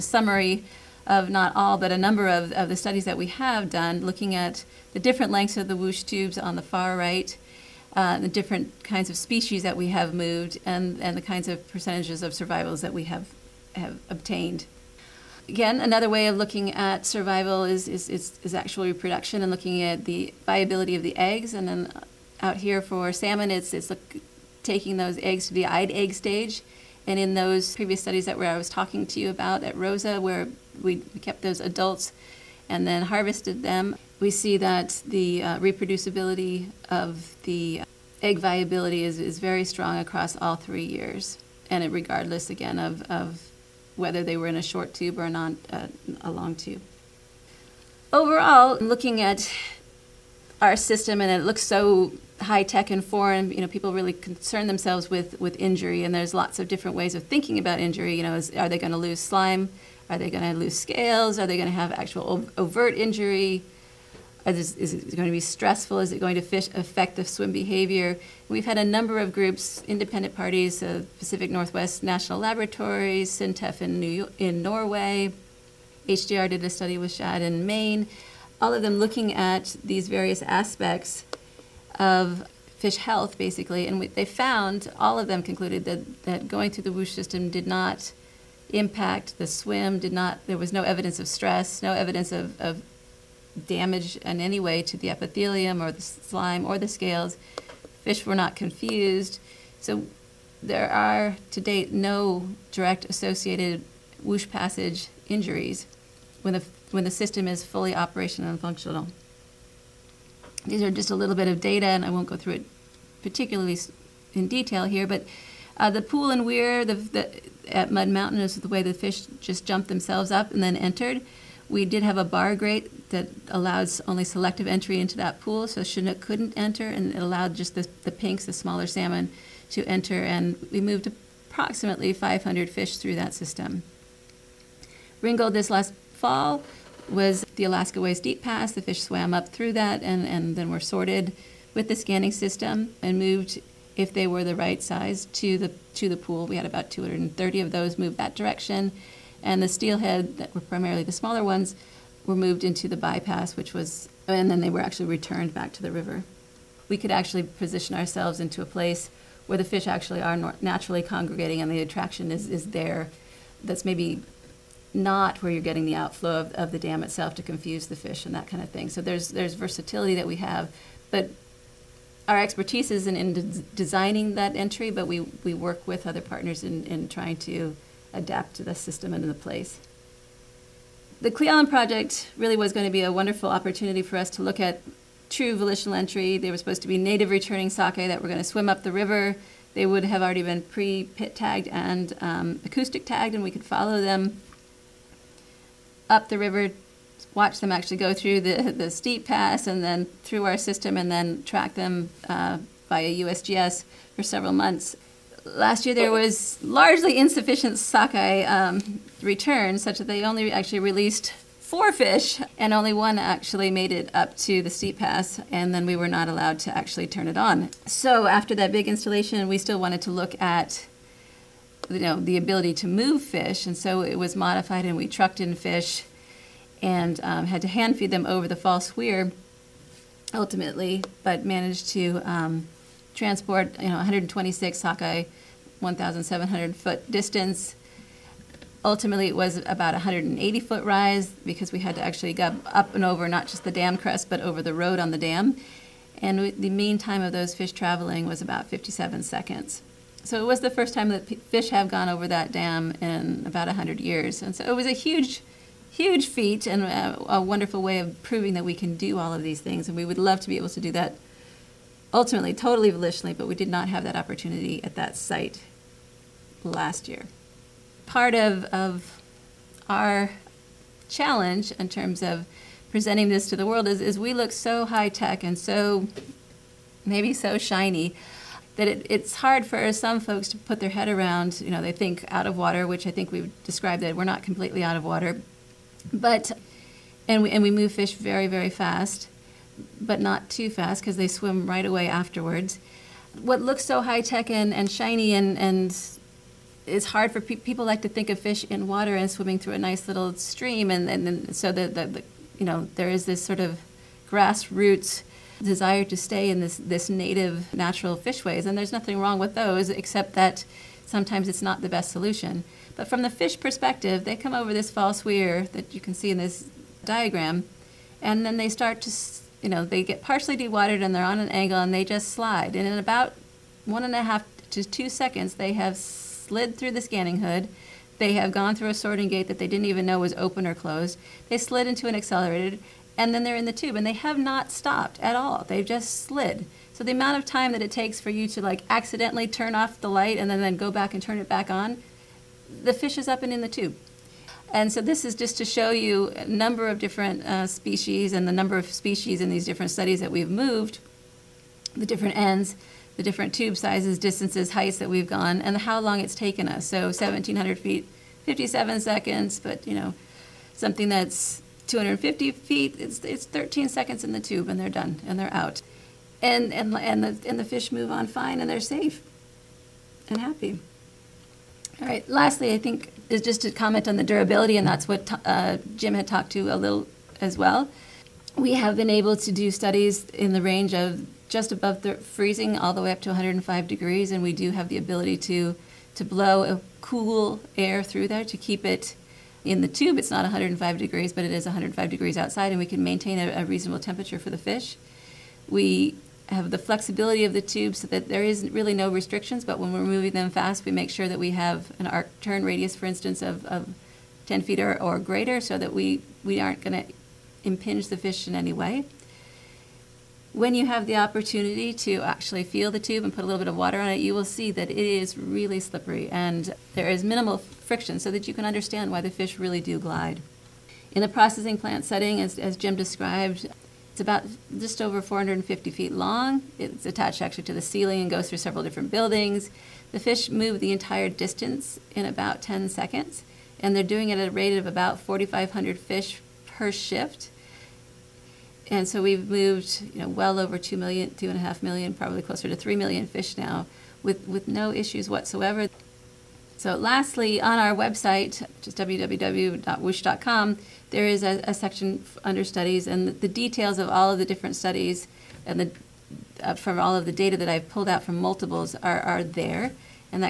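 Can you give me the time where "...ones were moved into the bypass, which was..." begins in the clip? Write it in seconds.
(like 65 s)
151 s.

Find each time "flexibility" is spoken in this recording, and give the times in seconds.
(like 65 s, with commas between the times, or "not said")
396 s.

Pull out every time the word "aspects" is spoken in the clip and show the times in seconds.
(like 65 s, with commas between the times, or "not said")
80 s.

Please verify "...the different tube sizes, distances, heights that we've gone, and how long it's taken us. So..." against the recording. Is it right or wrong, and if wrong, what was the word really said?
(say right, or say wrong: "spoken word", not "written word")
right.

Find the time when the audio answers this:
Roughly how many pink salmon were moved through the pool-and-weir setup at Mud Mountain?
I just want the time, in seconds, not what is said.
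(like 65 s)
132 s.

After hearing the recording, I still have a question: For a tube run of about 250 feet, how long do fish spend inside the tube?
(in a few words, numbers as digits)
13 seconds.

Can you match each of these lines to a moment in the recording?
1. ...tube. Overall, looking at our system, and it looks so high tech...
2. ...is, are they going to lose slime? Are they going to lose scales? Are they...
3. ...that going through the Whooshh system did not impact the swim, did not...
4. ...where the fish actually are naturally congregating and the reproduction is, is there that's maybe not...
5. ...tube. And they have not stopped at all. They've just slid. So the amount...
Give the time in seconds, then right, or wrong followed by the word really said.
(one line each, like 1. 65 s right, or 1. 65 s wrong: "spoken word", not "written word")
1. 46 s right
2. 58 s right
3. 86 s right
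4. 159 s wrong: "attraction", not "reproduction"
5. 333 s right.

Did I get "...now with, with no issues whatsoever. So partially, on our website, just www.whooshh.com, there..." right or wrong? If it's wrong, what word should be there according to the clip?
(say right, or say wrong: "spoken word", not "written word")
wrong: "lastly", not "partially".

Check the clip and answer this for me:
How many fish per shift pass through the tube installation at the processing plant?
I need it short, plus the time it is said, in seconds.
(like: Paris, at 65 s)
4,500, at 435 s.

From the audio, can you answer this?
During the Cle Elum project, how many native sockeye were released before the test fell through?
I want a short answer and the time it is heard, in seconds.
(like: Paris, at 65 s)
4, at 211 s.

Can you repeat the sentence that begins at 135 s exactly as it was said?
Ringold this last fall was the Alaska Way's Deep Pass.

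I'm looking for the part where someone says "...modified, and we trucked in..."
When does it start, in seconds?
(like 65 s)
224 s.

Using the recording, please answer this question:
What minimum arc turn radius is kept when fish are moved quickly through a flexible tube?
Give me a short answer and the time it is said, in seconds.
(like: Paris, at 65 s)
10 feet, at 404 s.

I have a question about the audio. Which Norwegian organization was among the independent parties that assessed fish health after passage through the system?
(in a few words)
SINTEF.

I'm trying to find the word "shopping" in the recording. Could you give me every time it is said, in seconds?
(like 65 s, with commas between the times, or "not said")
not said.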